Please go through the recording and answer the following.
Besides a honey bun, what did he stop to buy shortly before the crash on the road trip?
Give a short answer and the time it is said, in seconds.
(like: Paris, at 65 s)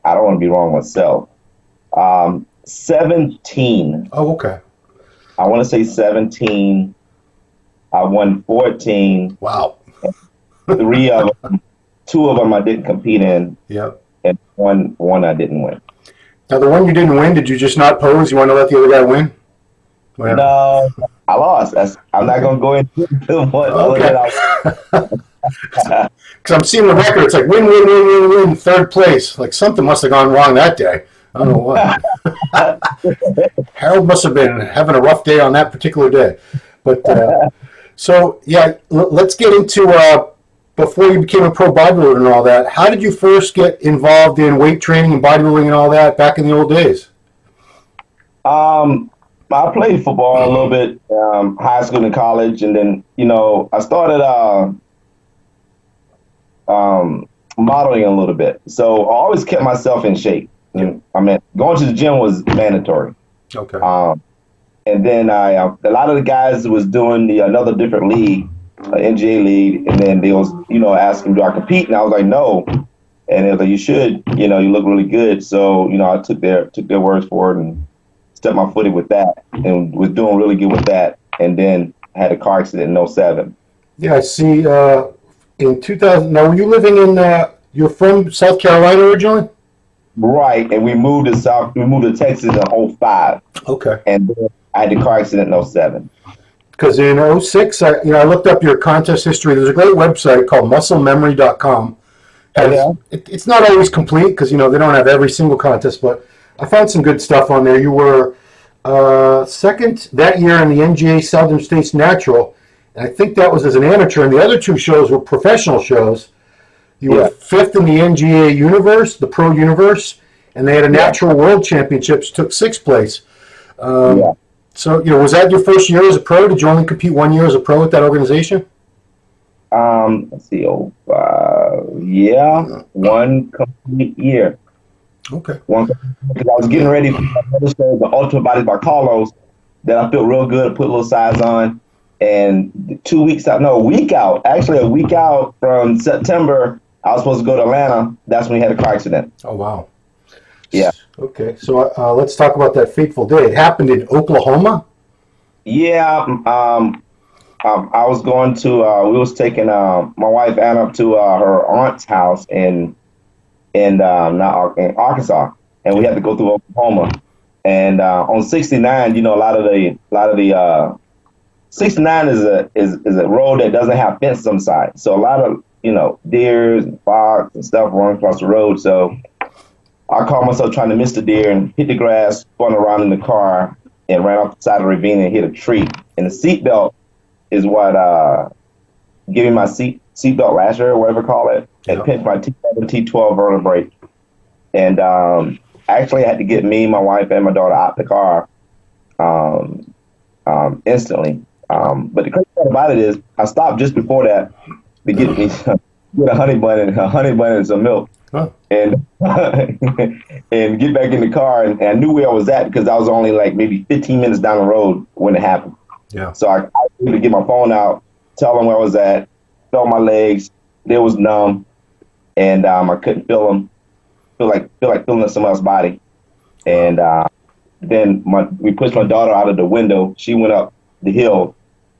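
Milk, at 207 s.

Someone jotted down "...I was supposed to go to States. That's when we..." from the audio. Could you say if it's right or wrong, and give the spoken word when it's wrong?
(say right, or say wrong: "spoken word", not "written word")
wrong: "Atlanta", not "States".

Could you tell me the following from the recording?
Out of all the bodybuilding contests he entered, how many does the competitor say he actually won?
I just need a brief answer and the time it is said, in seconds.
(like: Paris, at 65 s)
14, at 8 s.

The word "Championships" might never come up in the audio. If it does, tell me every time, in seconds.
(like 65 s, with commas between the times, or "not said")
121 s.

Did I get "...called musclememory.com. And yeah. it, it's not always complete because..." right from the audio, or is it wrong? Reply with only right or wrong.
right.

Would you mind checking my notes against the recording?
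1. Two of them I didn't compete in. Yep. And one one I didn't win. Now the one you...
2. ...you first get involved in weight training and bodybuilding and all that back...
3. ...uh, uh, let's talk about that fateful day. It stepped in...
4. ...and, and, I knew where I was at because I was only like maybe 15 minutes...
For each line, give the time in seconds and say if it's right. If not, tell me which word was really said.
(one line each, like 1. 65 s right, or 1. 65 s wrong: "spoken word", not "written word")
1. 12 s right
2. 43 s right
3. 151 s wrong: "happened", not "stepped"
4. 211 s right.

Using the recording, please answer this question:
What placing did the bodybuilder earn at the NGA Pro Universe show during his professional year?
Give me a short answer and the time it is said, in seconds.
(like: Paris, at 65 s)
Fifth, at 117 s.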